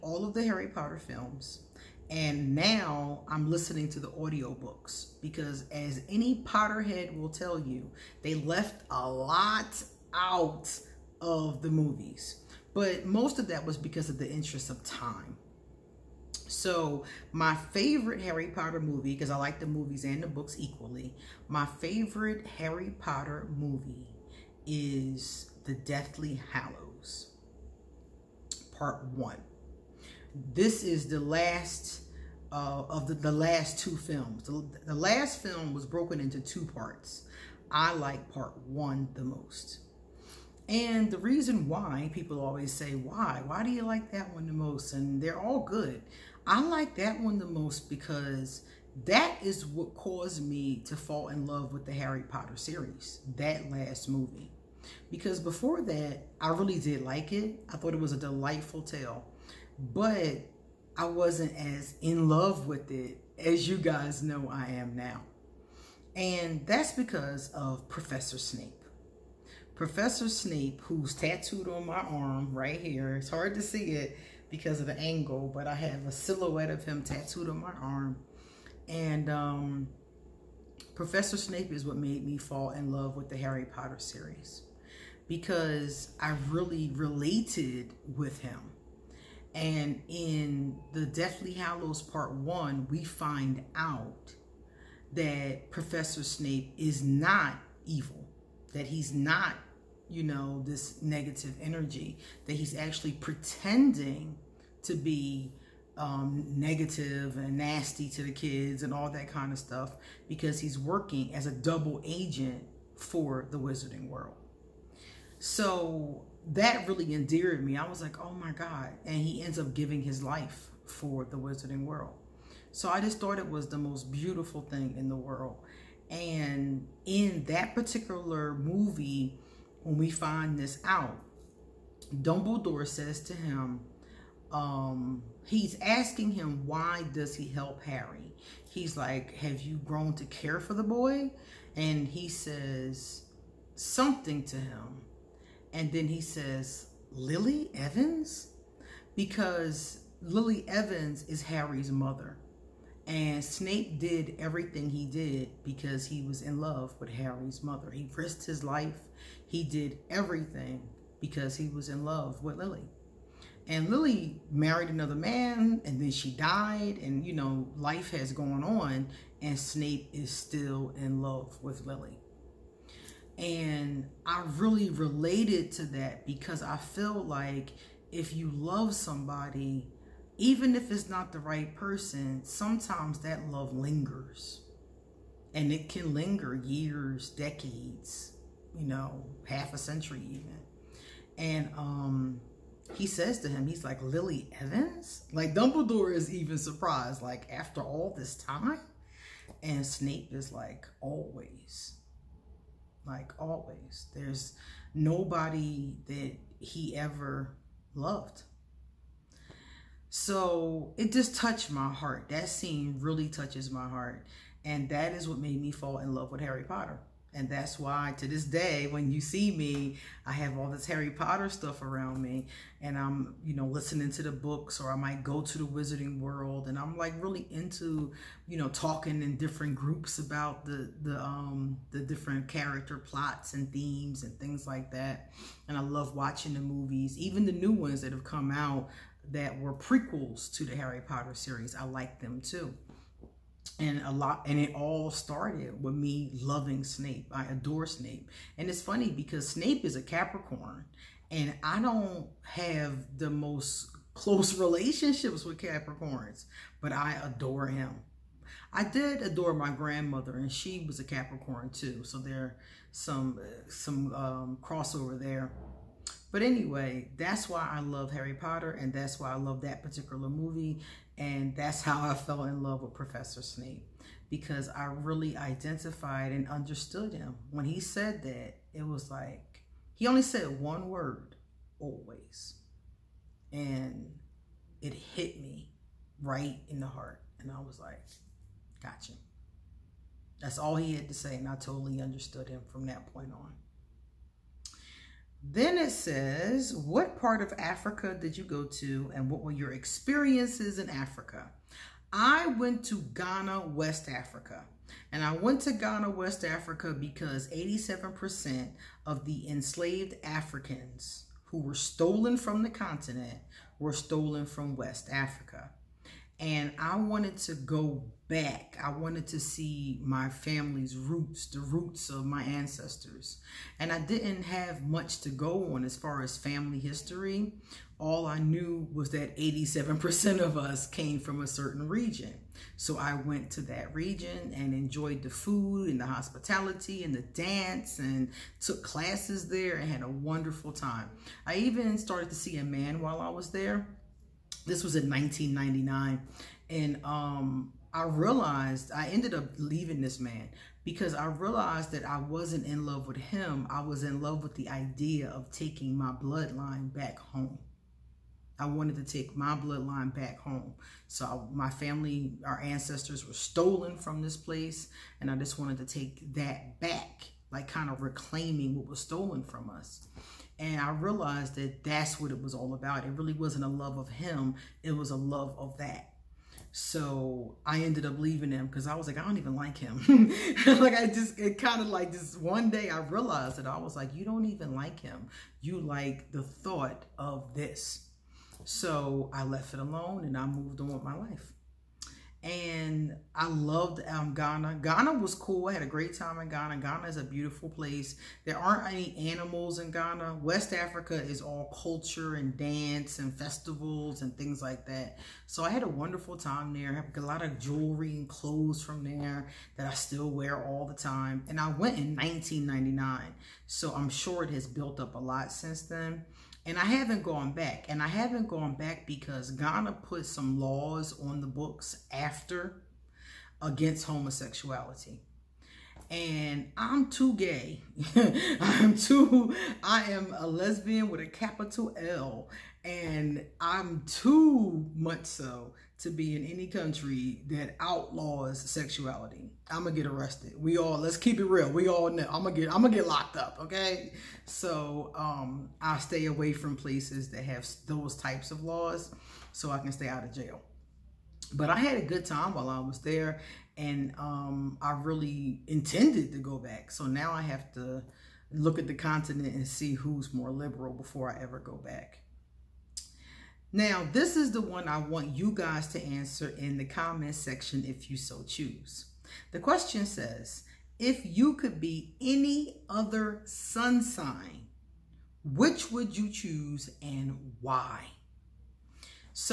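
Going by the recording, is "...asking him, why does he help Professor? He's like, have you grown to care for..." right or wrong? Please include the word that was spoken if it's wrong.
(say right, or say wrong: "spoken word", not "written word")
wrong: "Harry", not "Professor".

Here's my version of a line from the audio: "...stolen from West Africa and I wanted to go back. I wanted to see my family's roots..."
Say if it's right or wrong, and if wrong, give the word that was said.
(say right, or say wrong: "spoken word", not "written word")
right.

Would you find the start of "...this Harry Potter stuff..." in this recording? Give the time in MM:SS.
03:40.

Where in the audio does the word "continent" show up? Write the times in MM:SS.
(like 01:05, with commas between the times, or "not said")
05:12, 07:38.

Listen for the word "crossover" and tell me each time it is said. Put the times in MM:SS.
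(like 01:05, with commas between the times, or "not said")
04:24.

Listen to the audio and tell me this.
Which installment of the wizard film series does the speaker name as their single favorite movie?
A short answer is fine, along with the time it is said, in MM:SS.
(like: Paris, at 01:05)
Deathly Hallows Part 1, at 00:25.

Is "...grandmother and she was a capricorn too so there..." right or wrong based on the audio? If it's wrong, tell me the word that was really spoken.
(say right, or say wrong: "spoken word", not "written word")
right.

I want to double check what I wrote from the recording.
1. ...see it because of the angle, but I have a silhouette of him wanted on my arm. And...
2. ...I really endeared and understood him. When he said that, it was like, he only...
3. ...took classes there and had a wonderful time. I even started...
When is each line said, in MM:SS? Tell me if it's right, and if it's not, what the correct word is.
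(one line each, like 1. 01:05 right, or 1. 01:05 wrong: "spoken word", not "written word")
1. 01:13 wrong: "tattooed", not "wanted"
2. 04:34 wrong: "identified", not "endeared"
3. 05:38 right.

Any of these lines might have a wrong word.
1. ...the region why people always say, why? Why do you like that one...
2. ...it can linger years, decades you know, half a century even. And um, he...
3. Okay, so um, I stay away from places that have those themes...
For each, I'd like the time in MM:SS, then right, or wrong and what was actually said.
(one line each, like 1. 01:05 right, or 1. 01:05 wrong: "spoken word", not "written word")
1. 00:41 wrong: "reason", not "region"
2. 03:05 right
3. 07:23 wrong: "types", not "themes".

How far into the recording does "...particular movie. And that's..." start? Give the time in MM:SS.
04:29.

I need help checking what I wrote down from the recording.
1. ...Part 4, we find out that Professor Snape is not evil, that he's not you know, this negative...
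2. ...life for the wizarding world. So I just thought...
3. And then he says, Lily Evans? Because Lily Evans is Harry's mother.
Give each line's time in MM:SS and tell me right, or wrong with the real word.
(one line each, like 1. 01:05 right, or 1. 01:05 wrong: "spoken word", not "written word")
1. 01:32 wrong: "1", not "4"
2. 02:00 right
3. 02:25 right.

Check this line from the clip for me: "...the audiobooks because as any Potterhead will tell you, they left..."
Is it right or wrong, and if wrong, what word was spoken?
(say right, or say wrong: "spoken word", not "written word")
right.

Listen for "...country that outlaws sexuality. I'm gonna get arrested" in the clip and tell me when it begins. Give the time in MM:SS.
07:16.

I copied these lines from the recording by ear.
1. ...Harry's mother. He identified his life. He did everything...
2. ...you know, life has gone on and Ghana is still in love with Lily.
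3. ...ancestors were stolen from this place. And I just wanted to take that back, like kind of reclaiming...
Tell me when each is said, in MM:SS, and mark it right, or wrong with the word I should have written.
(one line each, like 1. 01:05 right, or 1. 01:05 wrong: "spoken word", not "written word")
1. 02:37 wrong: "risked", not "identified"
2. 02:47 wrong: "Snape", not "Ghana"
3. 06:02 right.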